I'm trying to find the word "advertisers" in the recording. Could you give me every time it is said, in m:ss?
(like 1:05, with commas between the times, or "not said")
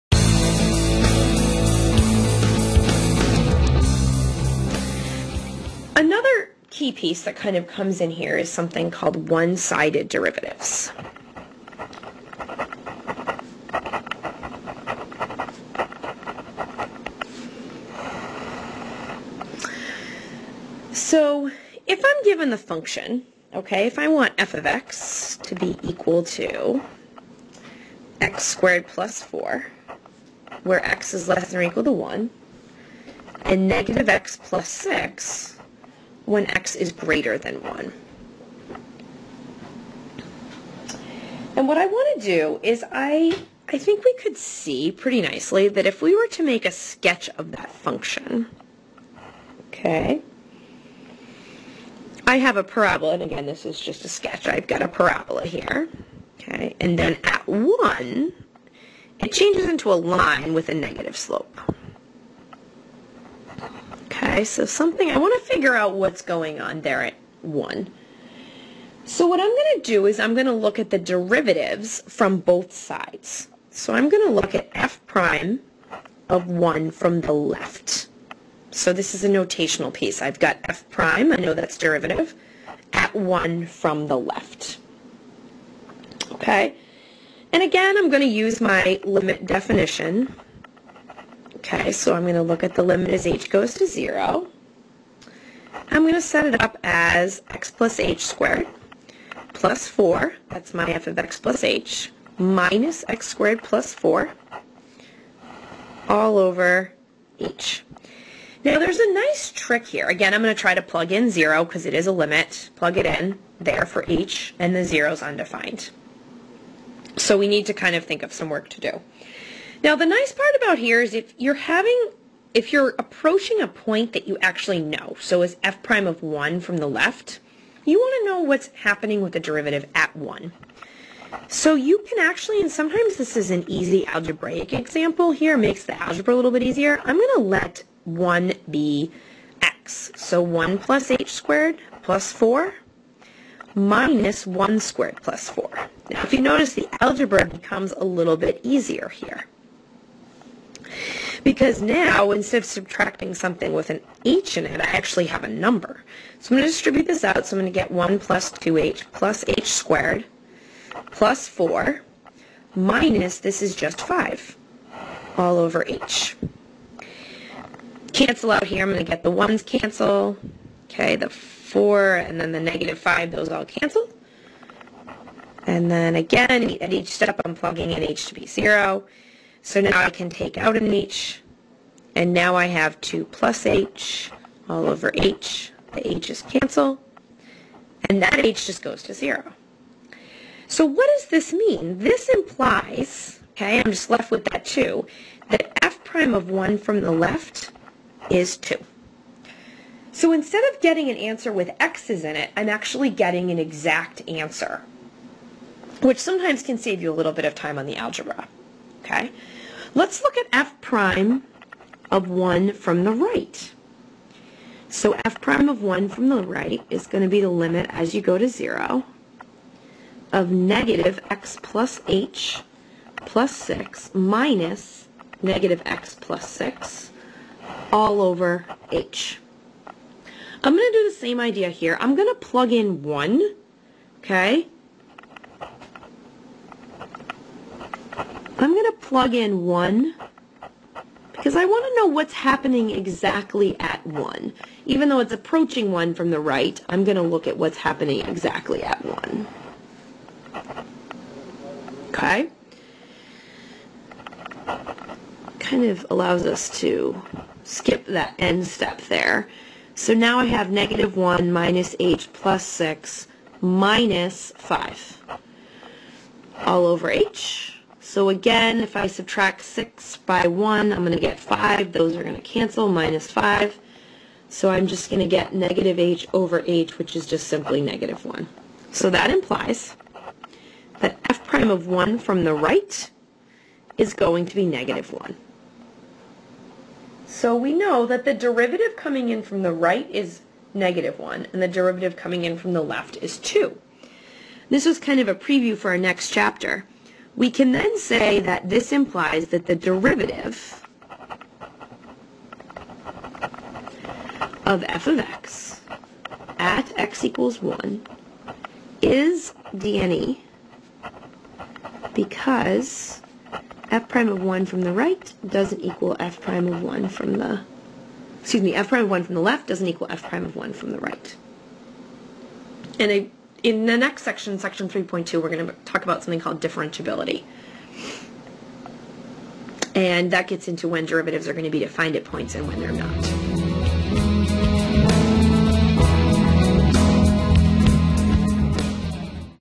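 not said.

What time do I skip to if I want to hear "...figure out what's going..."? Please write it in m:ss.
1:05.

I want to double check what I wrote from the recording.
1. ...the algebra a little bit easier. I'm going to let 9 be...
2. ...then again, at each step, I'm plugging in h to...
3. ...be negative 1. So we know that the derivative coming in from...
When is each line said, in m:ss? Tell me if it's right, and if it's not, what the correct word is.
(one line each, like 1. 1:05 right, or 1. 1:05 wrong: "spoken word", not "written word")
1. 2:15 wrong: "1", not "9"
2. 2:55 right
3. 4:44 right.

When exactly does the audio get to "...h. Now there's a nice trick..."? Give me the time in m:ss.
1:47.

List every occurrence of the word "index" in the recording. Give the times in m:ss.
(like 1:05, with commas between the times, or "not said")
not said.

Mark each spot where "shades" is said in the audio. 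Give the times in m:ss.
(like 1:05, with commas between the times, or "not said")
not said.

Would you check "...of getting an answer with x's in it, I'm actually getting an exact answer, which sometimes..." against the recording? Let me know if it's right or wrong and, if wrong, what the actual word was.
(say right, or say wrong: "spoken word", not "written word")
right.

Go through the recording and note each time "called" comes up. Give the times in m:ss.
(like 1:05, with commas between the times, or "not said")
0:08, 5:26.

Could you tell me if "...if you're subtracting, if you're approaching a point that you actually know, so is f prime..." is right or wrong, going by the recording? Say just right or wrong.
wrong.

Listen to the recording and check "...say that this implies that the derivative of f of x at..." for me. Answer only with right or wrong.
right.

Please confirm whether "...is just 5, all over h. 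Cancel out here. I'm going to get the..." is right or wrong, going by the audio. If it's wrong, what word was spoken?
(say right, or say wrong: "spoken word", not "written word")
right.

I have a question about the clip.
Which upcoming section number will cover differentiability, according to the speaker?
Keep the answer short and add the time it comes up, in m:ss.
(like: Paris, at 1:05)
3.2, at 5:24.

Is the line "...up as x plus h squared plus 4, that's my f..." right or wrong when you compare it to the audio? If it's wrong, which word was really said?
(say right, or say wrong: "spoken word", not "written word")
right.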